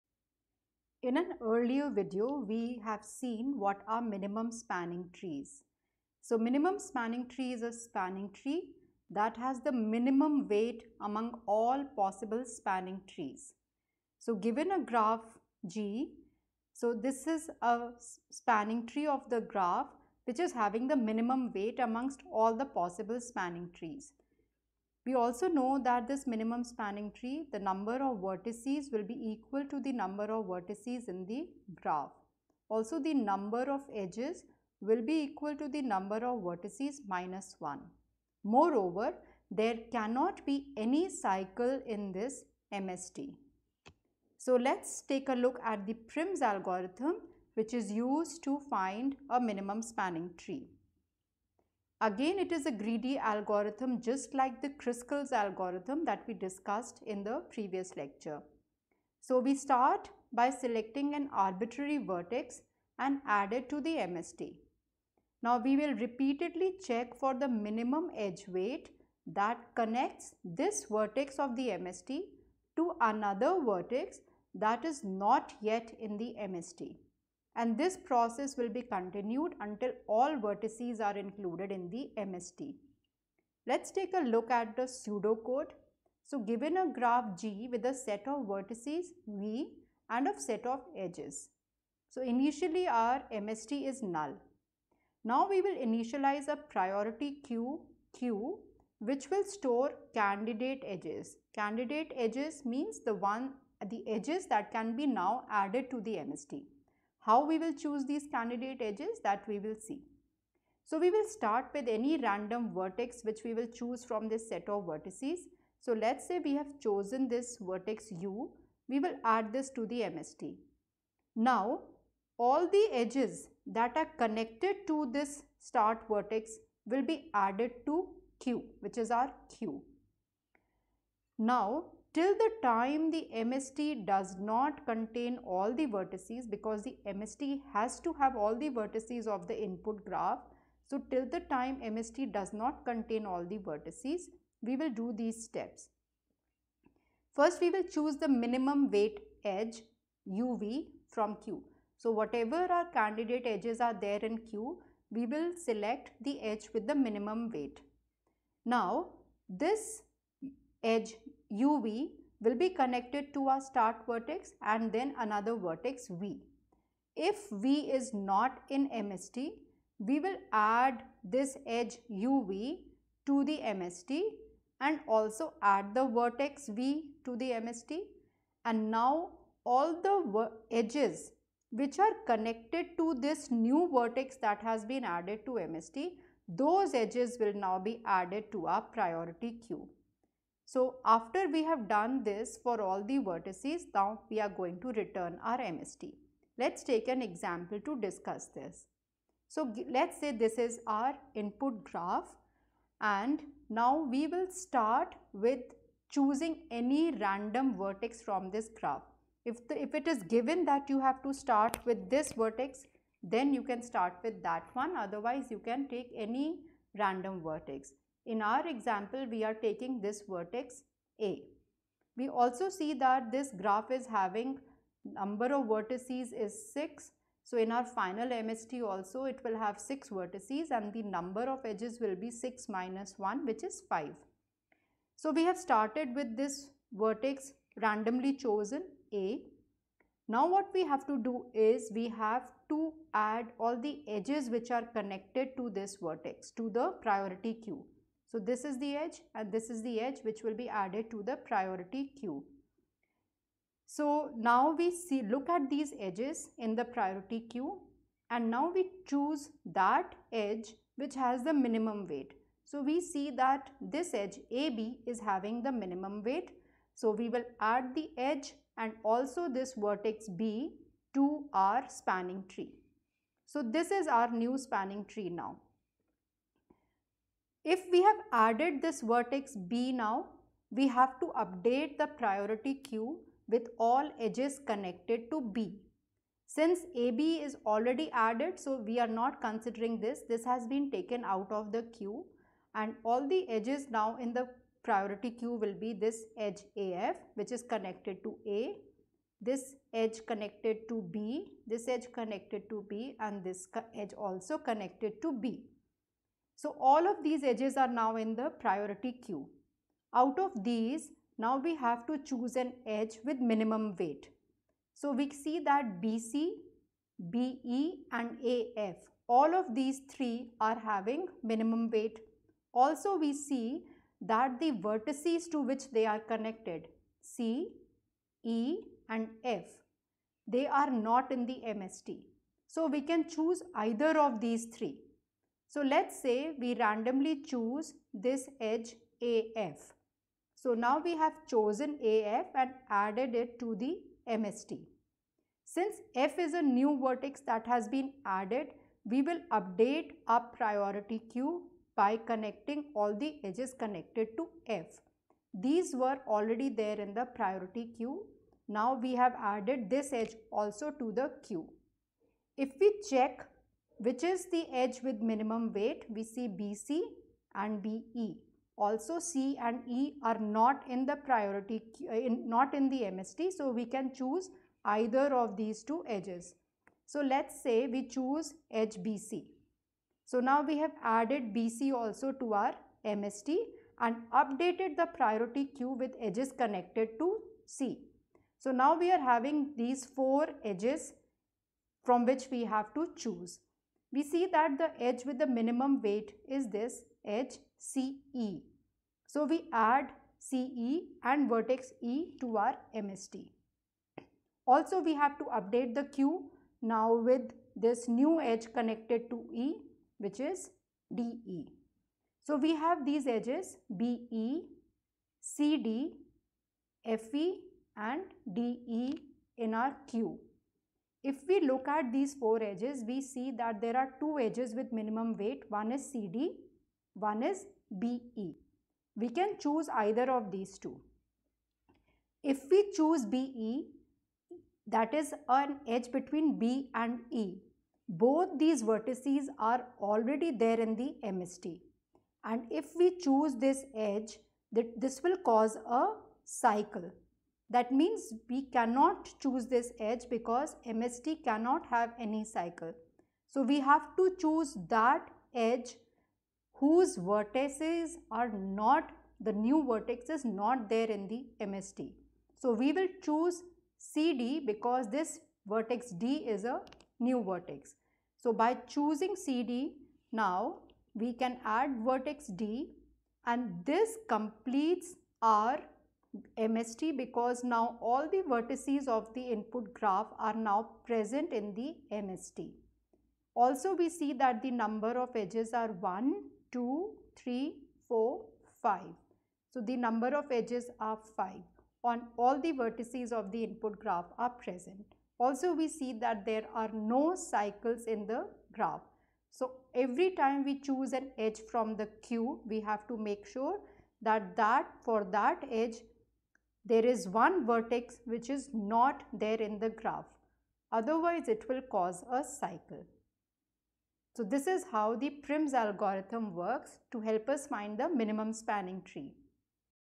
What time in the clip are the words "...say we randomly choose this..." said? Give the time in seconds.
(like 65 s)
336 s.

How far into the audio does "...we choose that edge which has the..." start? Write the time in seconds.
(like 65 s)
258 s.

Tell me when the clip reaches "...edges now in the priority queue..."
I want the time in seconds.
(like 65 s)
293 s.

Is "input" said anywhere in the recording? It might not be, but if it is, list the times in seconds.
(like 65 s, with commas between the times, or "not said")
139 s, 201 s, 479 s, 493 s.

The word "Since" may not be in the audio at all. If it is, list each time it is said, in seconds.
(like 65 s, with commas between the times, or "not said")
286 s, 345 s.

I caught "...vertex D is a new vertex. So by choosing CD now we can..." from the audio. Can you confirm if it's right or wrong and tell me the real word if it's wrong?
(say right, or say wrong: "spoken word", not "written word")
right.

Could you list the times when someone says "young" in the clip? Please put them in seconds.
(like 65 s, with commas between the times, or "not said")
not said.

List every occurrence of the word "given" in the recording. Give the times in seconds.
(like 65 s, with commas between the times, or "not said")
14 s, 86 s, 210 s.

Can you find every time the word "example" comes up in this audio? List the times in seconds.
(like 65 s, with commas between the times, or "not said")
197 s, 218 s.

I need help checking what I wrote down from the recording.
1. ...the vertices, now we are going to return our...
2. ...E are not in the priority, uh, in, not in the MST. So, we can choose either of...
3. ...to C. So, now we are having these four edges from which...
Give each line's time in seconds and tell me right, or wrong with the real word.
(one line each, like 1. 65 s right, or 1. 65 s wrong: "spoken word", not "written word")
1. 193 s right
2. 369 s right
3. 387 s right.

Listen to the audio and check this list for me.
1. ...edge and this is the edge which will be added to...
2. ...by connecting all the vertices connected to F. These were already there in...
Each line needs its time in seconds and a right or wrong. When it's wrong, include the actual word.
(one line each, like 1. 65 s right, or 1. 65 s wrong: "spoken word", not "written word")
1. 248 s right
2. 351 s wrong: "edges", not "vertices".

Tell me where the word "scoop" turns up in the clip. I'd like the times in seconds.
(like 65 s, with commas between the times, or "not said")
not said.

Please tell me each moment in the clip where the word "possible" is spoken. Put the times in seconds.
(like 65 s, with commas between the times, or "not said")
11 s, 22 s.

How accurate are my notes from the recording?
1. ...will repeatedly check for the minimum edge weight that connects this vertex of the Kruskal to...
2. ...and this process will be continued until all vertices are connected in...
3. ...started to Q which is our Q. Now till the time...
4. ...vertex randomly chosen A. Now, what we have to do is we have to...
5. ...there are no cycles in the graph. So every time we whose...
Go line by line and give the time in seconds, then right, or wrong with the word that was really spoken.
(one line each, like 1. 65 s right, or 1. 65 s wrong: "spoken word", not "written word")
1. 65 s wrong: "MST", not "Kruskal"
2. 77 s wrong: "included", not "connected"
3. 127 s wrong: "added", not "started"
4. 236 s right
5. 496 s wrong: "choose", not "whose".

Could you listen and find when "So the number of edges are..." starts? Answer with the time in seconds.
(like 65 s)
489 s.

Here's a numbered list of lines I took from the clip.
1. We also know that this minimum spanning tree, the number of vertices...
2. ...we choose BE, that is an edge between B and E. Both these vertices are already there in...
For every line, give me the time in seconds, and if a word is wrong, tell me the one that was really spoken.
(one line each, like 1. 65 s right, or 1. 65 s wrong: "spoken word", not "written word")
1. 25 s right
2. 432 s right.